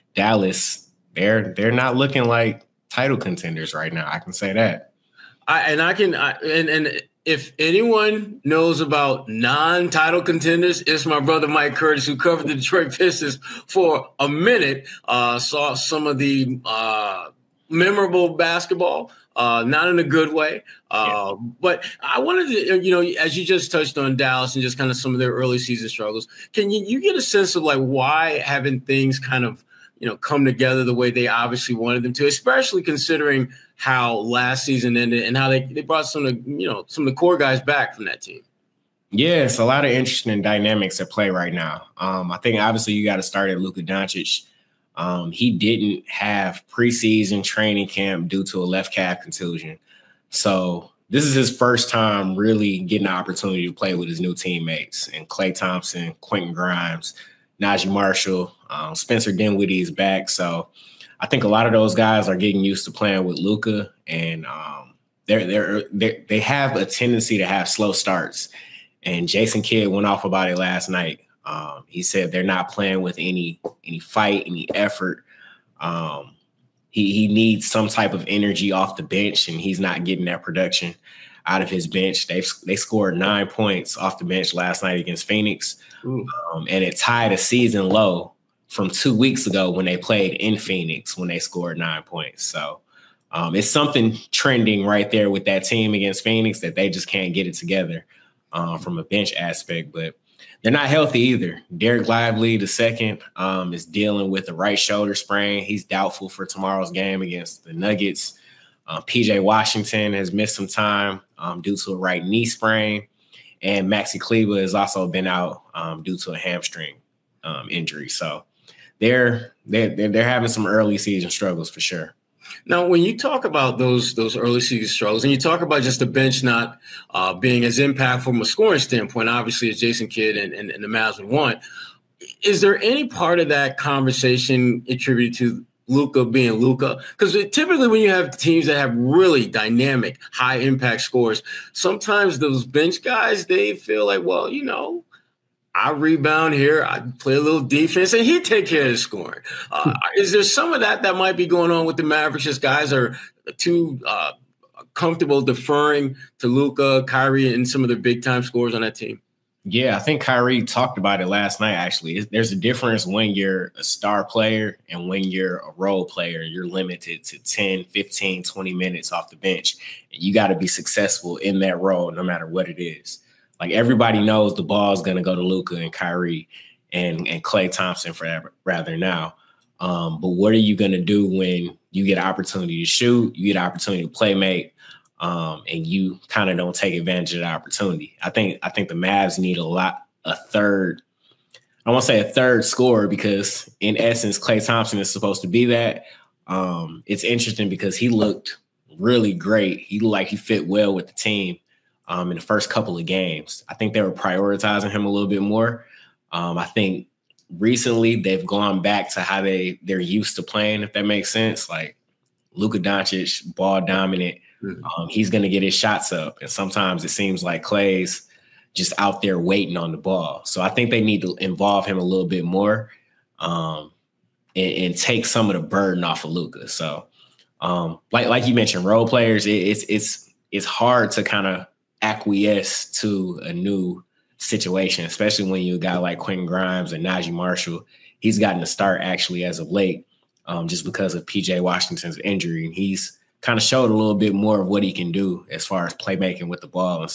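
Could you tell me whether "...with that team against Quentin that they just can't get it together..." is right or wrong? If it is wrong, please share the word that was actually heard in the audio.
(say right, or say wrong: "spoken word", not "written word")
wrong: "Phoenix", not "Quentin".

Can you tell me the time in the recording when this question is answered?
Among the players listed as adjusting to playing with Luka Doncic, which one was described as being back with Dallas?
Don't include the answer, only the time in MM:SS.
00:58.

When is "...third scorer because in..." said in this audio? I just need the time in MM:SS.
03:12.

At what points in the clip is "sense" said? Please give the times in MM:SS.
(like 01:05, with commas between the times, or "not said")
00:27, 03:31.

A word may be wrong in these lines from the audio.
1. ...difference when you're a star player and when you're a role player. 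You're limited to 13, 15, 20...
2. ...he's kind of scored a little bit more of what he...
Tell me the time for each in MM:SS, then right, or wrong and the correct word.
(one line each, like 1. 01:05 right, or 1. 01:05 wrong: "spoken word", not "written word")
1. 02:42 wrong: "10", not "13"
2. 04:02 wrong: "showed", not "scored".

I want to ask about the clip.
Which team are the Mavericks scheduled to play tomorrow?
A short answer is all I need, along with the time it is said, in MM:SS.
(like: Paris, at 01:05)
Nuggets, at 01:47.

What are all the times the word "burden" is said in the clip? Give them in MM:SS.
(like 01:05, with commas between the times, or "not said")
03:45.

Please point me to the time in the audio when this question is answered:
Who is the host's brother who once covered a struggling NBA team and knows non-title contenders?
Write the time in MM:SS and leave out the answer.
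00:11.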